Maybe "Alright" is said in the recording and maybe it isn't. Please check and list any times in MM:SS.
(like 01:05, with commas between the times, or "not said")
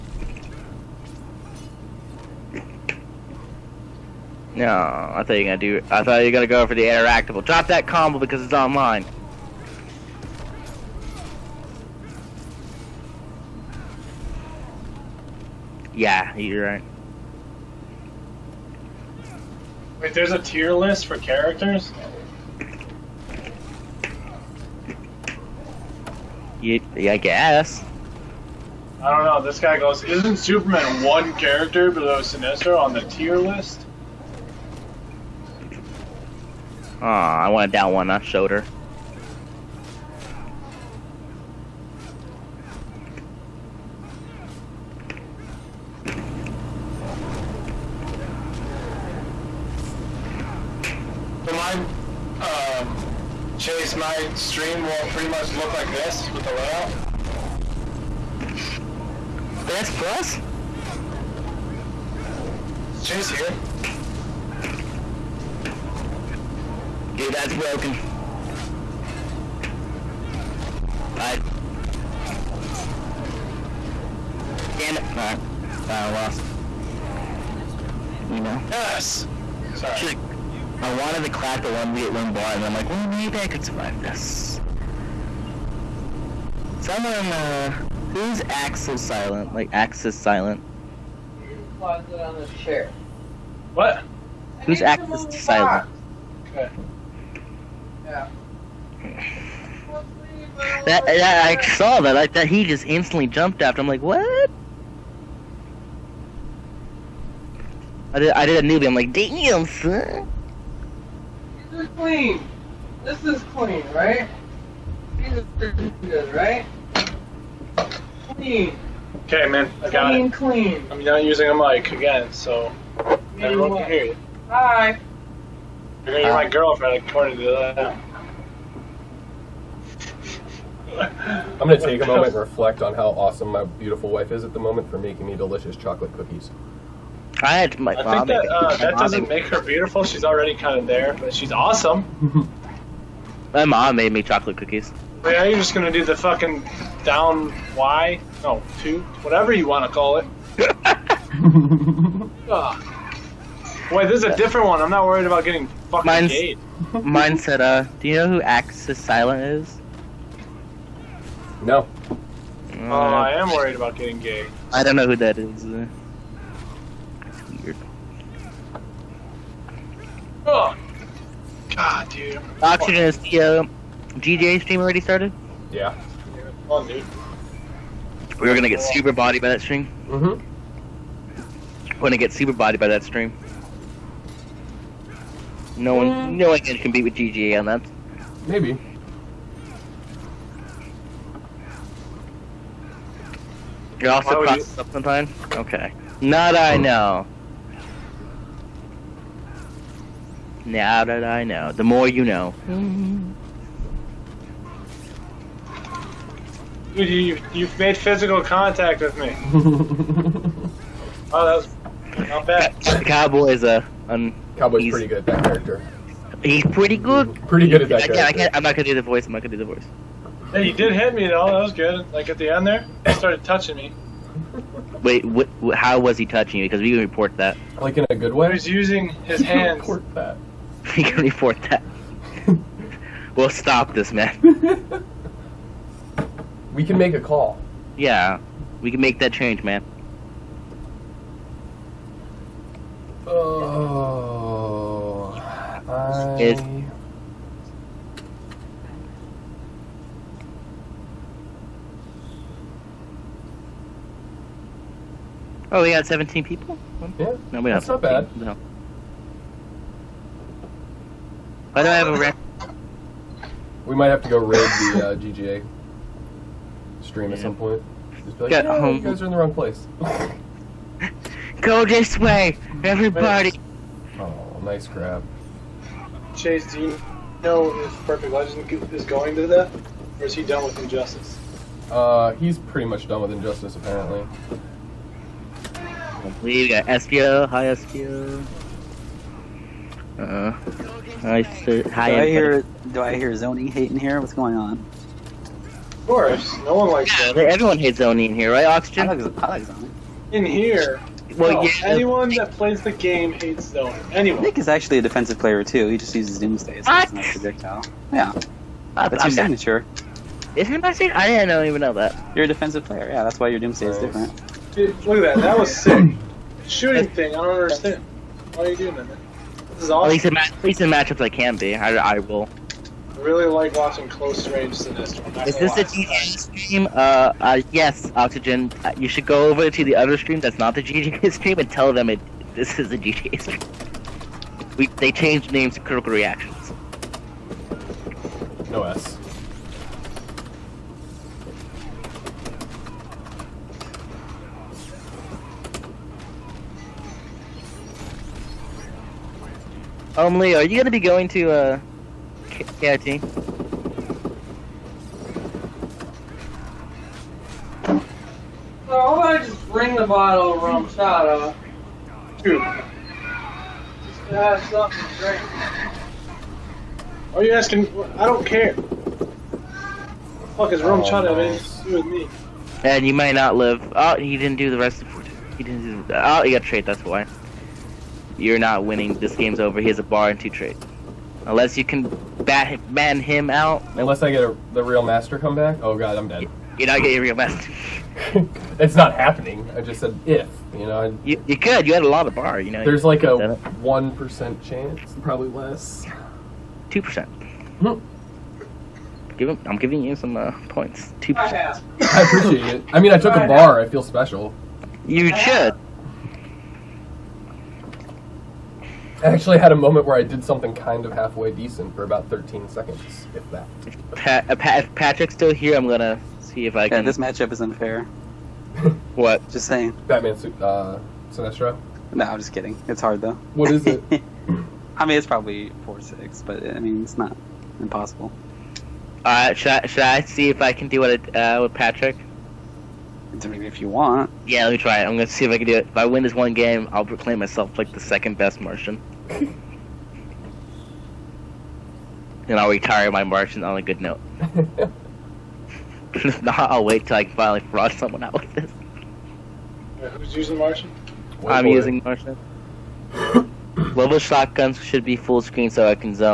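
01:15, 07:09.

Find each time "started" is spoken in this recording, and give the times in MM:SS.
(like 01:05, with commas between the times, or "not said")
02:55, 03:43.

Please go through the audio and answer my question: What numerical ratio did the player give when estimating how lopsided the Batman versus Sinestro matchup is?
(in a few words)
4-6.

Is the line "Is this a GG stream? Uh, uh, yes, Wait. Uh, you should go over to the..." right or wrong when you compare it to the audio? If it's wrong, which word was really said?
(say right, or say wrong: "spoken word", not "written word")
wrong: "Oxygen", not "Wait".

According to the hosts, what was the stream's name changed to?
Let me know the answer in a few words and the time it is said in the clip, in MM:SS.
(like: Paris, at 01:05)
Critical Reactions, at 05:35.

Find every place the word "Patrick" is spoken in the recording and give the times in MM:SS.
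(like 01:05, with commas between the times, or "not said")
06:54, 07:11.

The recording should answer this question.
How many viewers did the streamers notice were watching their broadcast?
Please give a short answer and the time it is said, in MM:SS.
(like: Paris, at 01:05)
17, at 04:16.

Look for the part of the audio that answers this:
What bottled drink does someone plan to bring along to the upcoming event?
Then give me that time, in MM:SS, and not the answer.
06:00.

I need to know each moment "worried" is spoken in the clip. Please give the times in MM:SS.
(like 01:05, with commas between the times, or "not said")
02:35, 02:43.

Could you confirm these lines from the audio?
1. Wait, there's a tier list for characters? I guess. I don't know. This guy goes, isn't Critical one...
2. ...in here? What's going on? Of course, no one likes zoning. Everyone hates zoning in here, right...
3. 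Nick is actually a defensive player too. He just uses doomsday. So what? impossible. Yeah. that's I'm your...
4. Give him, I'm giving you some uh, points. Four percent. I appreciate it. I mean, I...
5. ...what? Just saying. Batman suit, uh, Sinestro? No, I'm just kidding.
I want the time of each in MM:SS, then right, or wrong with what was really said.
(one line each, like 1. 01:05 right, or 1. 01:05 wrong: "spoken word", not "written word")
1. 00:20 wrong: "Superman", not "Critical"
2. 04:53 right
3. 05:04 wrong: "projectile", not "impossible"
4. 06:39 wrong: "Two", not "Four"
5. 06:59 right.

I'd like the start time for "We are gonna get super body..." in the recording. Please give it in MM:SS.
02:58.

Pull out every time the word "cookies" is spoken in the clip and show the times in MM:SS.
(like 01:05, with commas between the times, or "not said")
02:16, 02:24.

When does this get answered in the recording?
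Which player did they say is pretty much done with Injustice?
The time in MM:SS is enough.
04:38.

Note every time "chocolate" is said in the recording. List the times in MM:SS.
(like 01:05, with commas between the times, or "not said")
02:15, 02:24.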